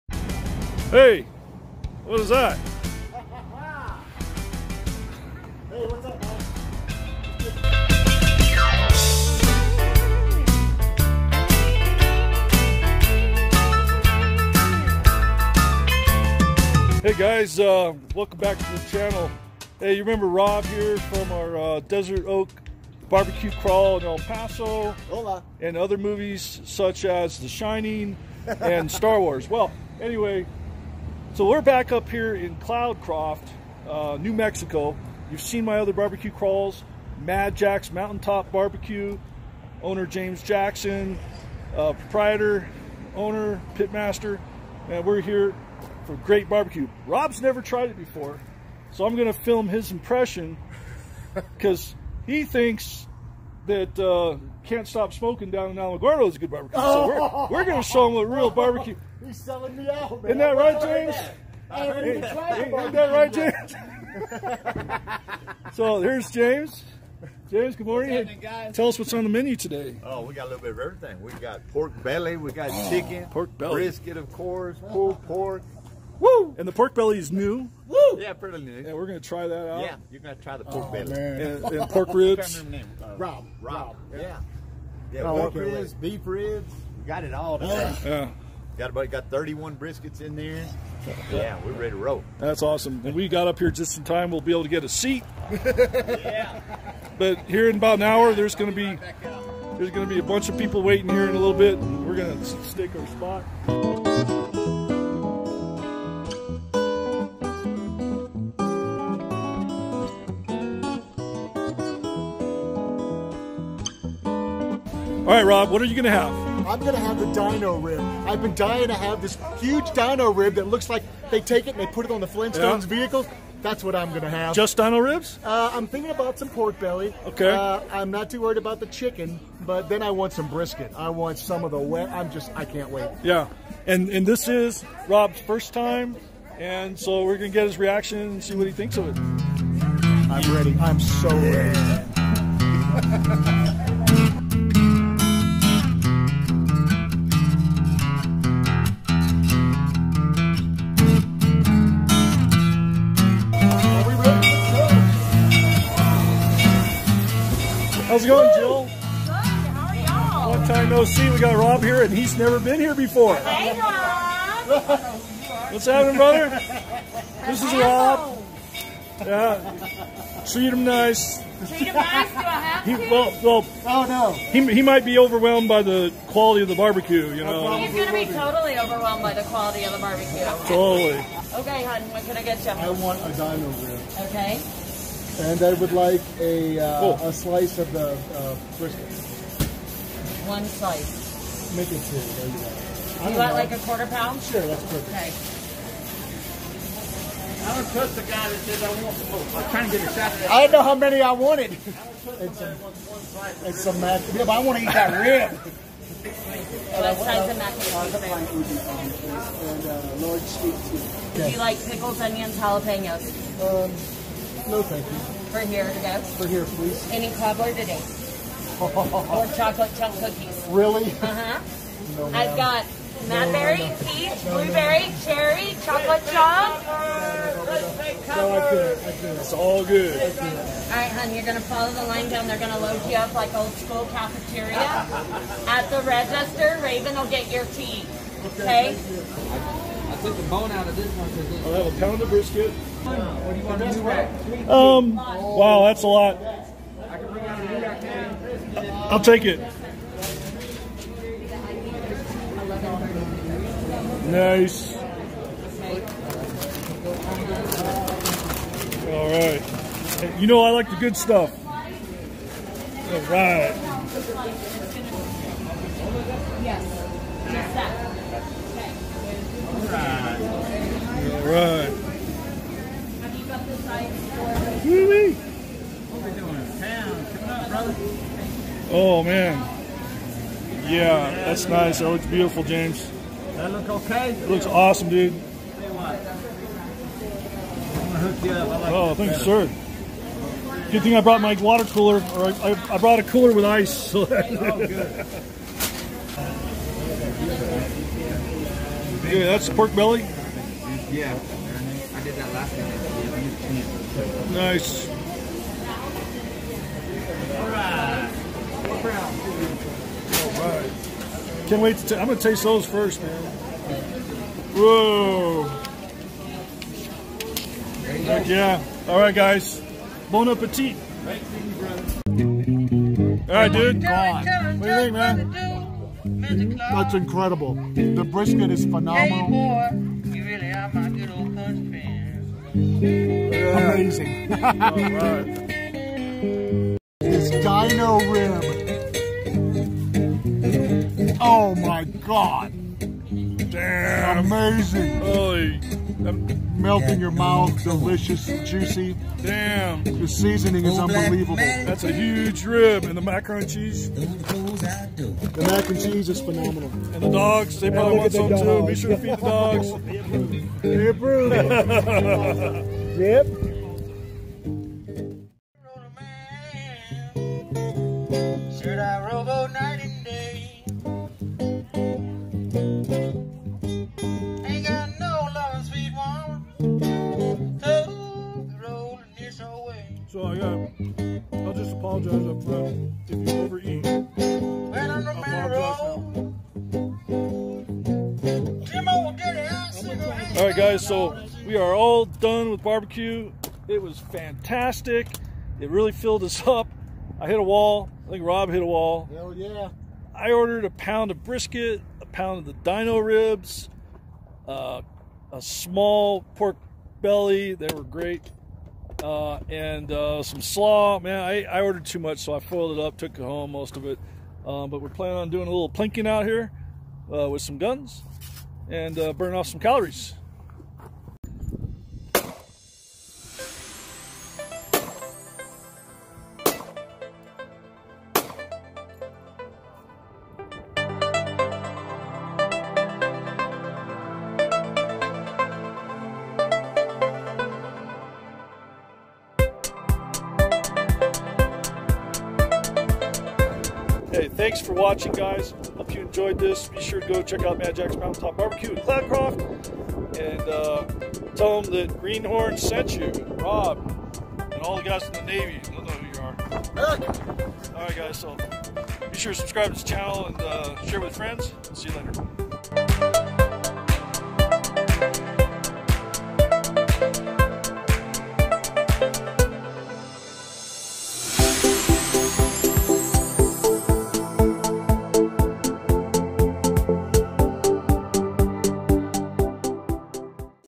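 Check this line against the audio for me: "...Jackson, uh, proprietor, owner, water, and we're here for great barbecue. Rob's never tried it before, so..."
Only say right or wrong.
wrong.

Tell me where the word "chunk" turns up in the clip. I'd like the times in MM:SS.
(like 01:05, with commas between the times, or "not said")
03:39, 03:46.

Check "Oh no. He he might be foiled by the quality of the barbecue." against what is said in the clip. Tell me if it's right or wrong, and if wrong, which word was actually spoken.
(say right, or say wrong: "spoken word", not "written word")
wrong: "overwhelmed", not "foiled".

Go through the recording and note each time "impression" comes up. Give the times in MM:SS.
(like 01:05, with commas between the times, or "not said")
00:49.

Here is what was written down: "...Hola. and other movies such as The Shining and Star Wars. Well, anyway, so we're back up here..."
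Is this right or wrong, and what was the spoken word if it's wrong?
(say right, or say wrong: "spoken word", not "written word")
right.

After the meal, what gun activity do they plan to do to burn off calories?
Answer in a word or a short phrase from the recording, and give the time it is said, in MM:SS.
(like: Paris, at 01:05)
Plinking, at 06:55.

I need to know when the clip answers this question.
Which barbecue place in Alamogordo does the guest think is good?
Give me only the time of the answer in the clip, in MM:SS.
00:54.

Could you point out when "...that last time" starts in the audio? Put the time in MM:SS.
05:02.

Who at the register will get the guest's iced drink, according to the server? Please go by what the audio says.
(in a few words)
Raven.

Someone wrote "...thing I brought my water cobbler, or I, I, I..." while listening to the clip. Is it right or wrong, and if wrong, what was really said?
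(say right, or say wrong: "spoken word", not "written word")
wrong: "cooler", not "cobbler".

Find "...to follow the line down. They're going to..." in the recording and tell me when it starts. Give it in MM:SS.
03:51.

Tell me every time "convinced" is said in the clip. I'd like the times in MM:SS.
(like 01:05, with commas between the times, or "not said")
not said.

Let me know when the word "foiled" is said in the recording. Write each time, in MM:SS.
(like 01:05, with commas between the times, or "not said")
06:52.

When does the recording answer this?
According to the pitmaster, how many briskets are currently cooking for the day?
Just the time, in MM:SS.
01:29.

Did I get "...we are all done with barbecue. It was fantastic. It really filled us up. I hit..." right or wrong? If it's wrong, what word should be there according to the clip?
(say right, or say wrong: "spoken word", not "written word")
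right.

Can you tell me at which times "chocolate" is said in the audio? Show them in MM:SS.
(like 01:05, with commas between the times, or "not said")
03:39, 03:45.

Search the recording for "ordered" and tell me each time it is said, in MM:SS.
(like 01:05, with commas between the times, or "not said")
06:40, 06:51.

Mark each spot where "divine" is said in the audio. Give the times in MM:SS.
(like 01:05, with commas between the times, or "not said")
not said.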